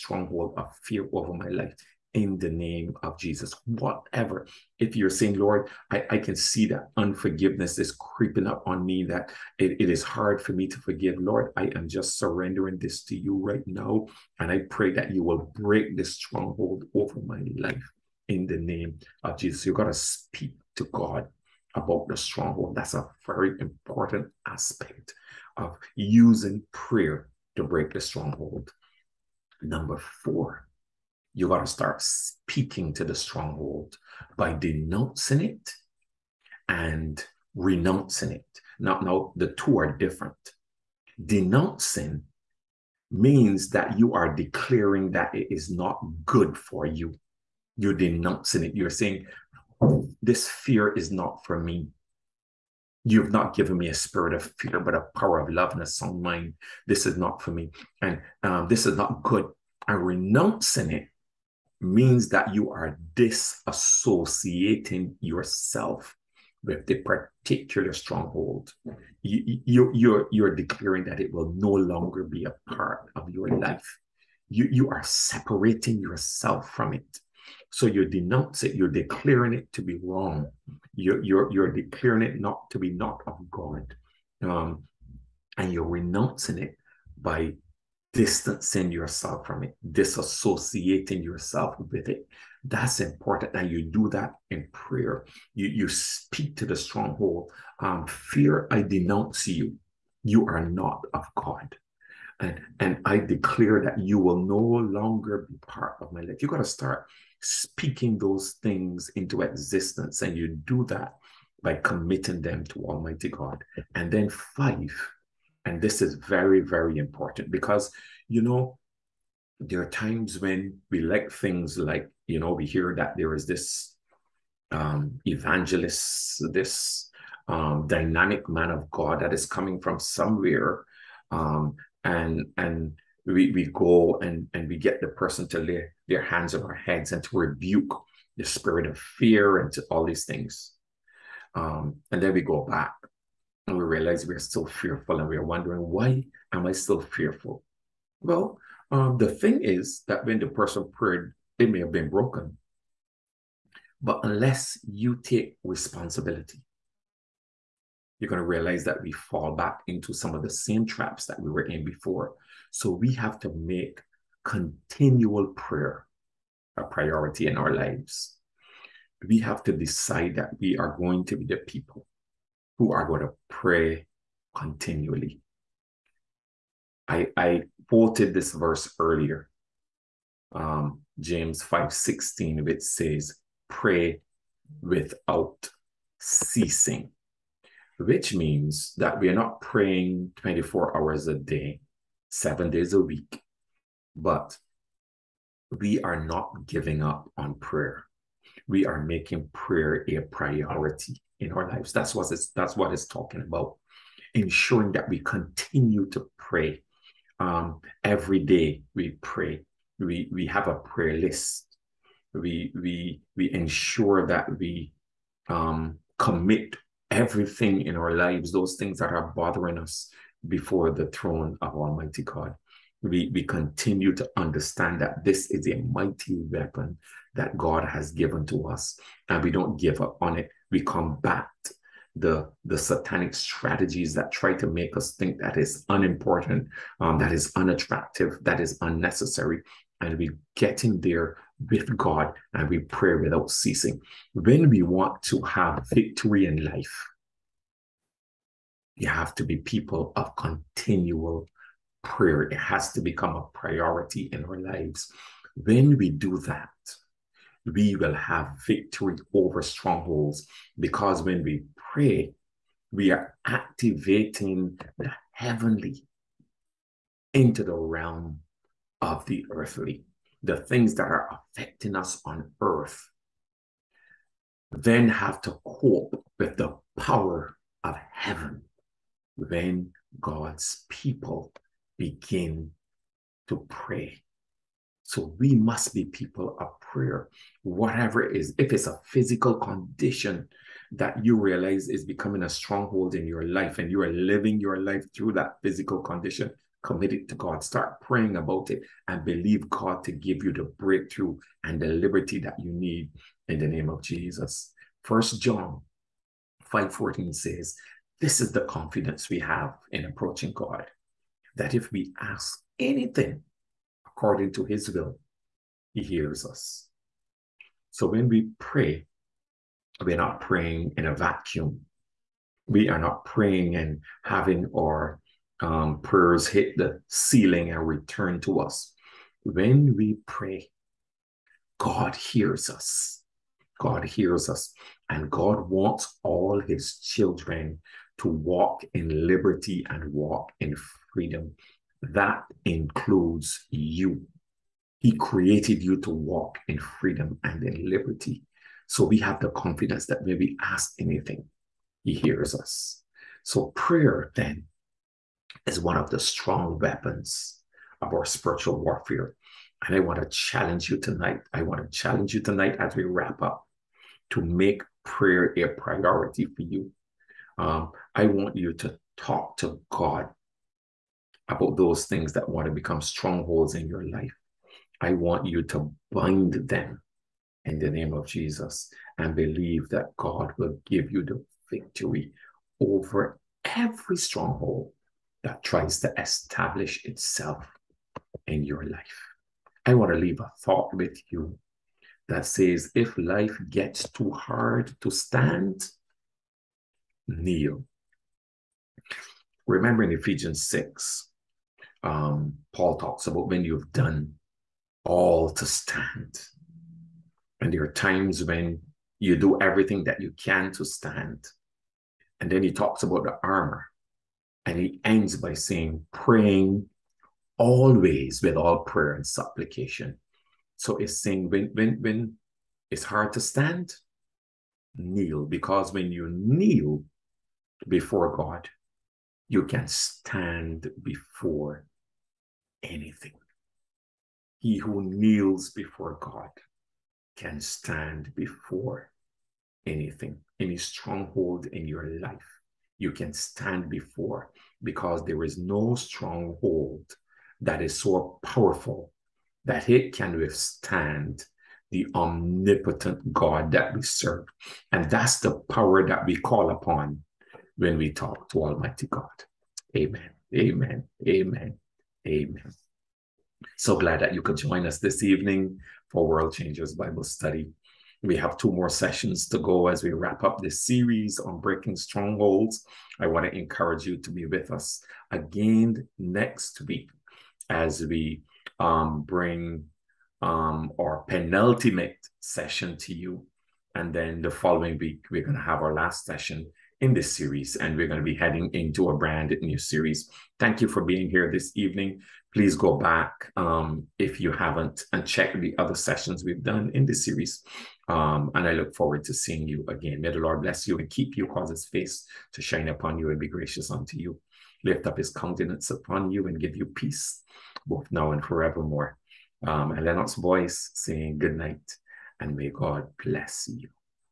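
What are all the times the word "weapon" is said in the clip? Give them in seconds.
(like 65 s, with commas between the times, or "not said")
226 s, 356 s.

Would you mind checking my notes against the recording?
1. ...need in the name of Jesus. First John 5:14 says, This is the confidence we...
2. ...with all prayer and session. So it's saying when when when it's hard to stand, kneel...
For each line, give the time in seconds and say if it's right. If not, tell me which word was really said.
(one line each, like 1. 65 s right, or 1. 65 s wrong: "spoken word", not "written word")
1. 302 s right
2. 418 s wrong: "supplication", not "session".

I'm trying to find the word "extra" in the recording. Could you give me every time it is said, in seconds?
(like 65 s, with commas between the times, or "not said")
not said.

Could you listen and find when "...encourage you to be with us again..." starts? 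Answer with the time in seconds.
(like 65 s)
473 s.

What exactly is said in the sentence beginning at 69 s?
You, you, you're, you're declaring that it will no longer be a part of your life.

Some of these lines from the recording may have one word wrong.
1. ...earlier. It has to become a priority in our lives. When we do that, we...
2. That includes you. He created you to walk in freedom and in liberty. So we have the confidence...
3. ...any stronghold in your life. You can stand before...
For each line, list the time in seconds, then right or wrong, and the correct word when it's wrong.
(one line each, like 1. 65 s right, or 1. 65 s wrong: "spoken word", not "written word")
1. 252 s wrong: "prayer", not "earlier"
2. 342 s right
3. 440 s right.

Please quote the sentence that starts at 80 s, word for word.
You're, you're, you're declaring it not to be not of God.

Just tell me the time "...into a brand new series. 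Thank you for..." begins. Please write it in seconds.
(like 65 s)
488 s.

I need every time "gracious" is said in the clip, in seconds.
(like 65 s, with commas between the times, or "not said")
503 s.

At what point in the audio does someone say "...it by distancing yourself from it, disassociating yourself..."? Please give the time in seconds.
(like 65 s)
86 s.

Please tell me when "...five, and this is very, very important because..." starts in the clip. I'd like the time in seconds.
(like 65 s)
114 s.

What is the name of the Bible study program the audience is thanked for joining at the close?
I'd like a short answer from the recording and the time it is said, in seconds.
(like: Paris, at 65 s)
World Changers Bible Study, at 466 s.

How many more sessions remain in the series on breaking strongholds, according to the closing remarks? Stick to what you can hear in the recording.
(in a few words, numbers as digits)
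2.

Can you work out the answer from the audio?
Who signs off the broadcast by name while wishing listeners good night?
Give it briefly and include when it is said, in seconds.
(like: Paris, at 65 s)
Lennox Boyce, at 510 s.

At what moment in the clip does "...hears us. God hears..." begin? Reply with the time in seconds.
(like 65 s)
332 s.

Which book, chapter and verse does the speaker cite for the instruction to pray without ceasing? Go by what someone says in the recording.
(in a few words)
James 5:16.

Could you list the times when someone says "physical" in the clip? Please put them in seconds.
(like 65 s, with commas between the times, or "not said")
289 s, 295 s.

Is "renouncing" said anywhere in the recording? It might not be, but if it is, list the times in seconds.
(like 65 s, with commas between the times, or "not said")
37 s, 60 s, 85 s.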